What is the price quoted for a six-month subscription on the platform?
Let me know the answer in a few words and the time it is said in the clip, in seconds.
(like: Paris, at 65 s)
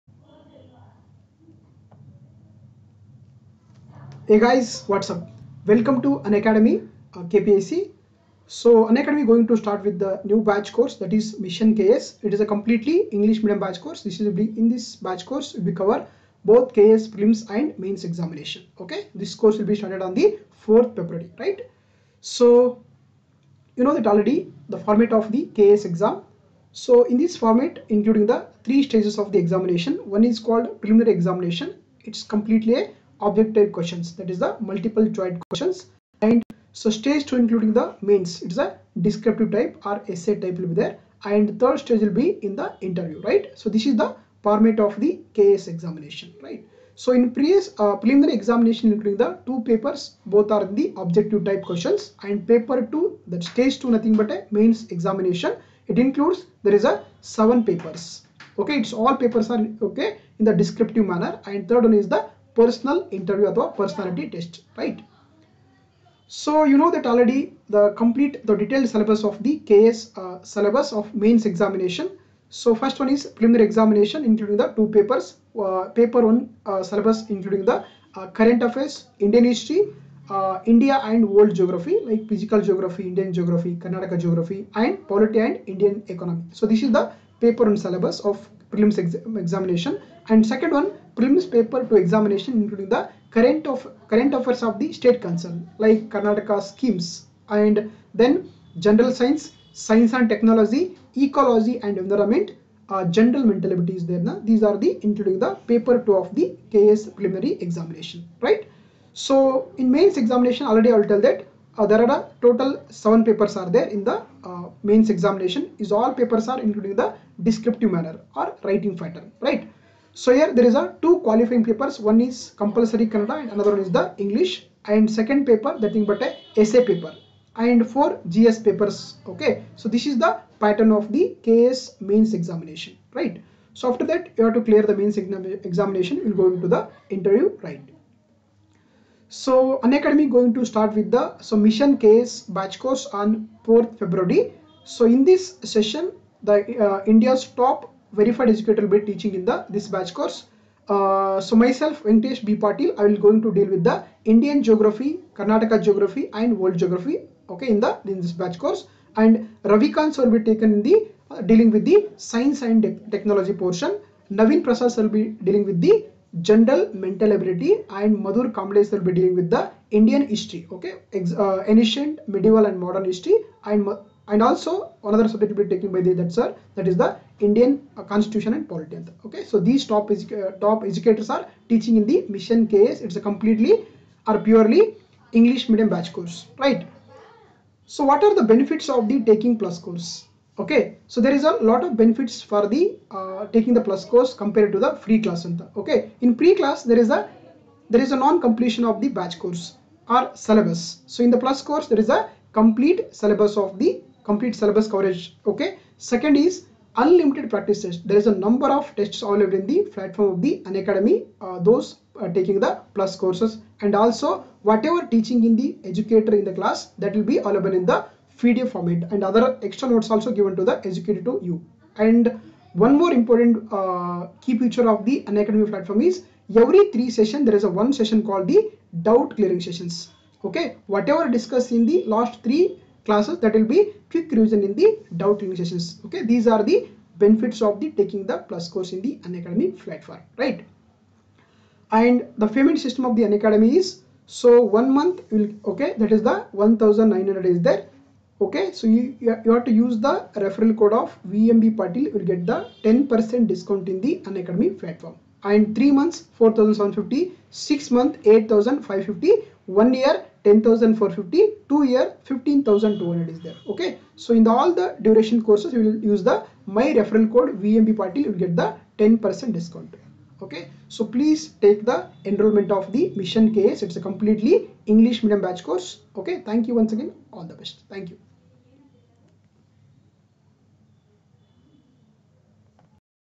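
8550, at 258 s.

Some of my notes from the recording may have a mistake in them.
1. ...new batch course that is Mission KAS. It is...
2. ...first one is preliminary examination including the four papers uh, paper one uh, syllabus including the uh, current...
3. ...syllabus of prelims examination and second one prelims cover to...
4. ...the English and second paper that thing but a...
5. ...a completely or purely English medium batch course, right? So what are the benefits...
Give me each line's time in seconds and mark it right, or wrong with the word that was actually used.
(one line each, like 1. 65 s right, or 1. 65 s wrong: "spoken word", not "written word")
1. 10 s right
2. 72 s wrong: "two", not "four"
3. 87 s wrong: "paper", not "cover"
4. 123 s right
5. 183 s right.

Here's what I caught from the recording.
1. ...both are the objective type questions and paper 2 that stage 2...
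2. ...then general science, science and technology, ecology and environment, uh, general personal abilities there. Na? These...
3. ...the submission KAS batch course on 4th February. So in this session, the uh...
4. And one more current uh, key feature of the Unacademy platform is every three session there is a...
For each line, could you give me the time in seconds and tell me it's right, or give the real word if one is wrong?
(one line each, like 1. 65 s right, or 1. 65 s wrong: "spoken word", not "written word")
1. 50 s right
2. 98 s wrong: "mental", not "personal"
3. 141 s right
4. 221 s wrong: "important", not "current".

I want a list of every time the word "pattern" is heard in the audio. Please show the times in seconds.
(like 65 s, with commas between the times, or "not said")
118 s, 130 s.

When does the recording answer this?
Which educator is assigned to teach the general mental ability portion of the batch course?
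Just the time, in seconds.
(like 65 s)
164 s.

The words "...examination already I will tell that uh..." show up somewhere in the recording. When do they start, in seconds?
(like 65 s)
110 s.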